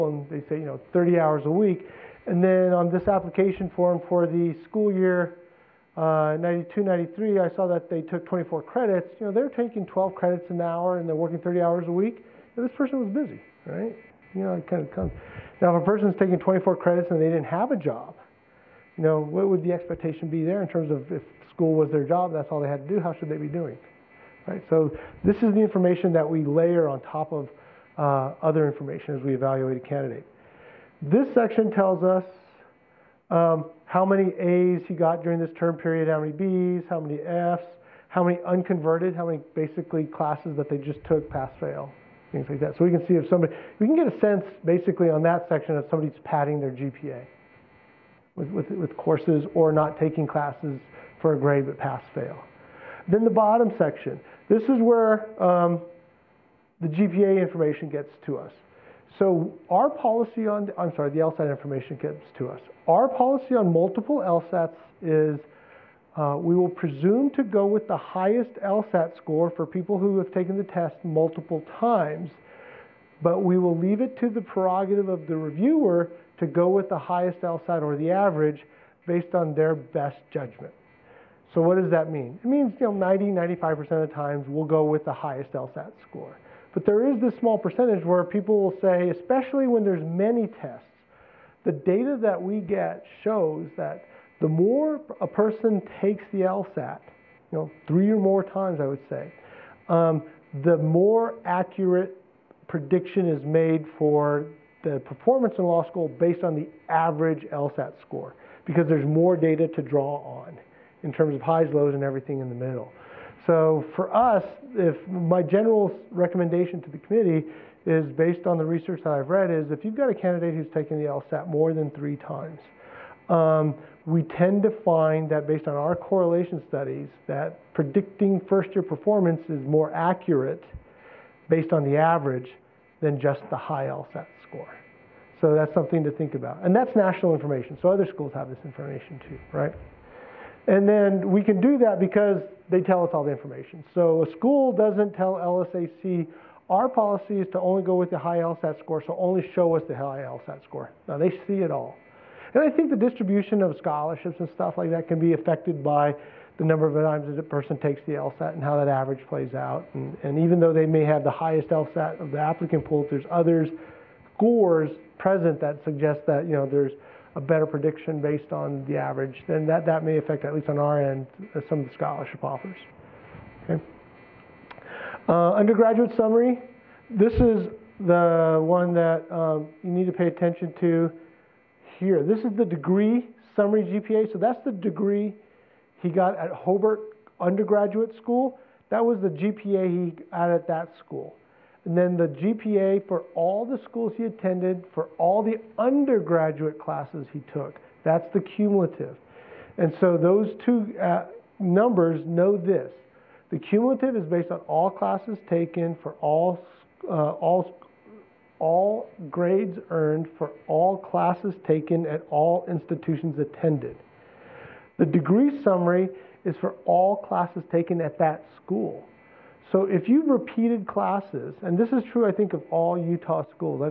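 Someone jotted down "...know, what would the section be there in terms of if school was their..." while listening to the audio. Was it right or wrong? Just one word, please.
wrong.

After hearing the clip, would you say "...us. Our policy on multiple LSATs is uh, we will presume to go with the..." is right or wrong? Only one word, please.
right.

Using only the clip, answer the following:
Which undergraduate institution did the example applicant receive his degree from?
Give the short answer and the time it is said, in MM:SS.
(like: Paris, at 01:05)
Hobart, at 03:06.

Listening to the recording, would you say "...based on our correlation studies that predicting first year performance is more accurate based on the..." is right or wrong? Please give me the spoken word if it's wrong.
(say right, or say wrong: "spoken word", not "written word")
right.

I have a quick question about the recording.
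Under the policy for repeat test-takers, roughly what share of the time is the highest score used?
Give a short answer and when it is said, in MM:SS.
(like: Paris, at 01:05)
90-95%, at 01:22.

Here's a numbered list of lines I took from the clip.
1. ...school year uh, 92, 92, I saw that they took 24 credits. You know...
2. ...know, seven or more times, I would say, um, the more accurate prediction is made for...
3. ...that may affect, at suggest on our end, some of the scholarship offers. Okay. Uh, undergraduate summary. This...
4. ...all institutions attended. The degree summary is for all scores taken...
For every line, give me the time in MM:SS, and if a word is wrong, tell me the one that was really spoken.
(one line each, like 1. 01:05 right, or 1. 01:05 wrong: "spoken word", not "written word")
1. 00:04 wrong: "93", not "92"
2. 01:37 wrong: "three", not "seven"
3. 02:49 wrong: "least", not "suggest"
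4. 03:32 wrong: "classes", not "scores".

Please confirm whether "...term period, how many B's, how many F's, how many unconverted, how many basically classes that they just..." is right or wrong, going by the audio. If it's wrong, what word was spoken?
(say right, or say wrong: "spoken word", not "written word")
right.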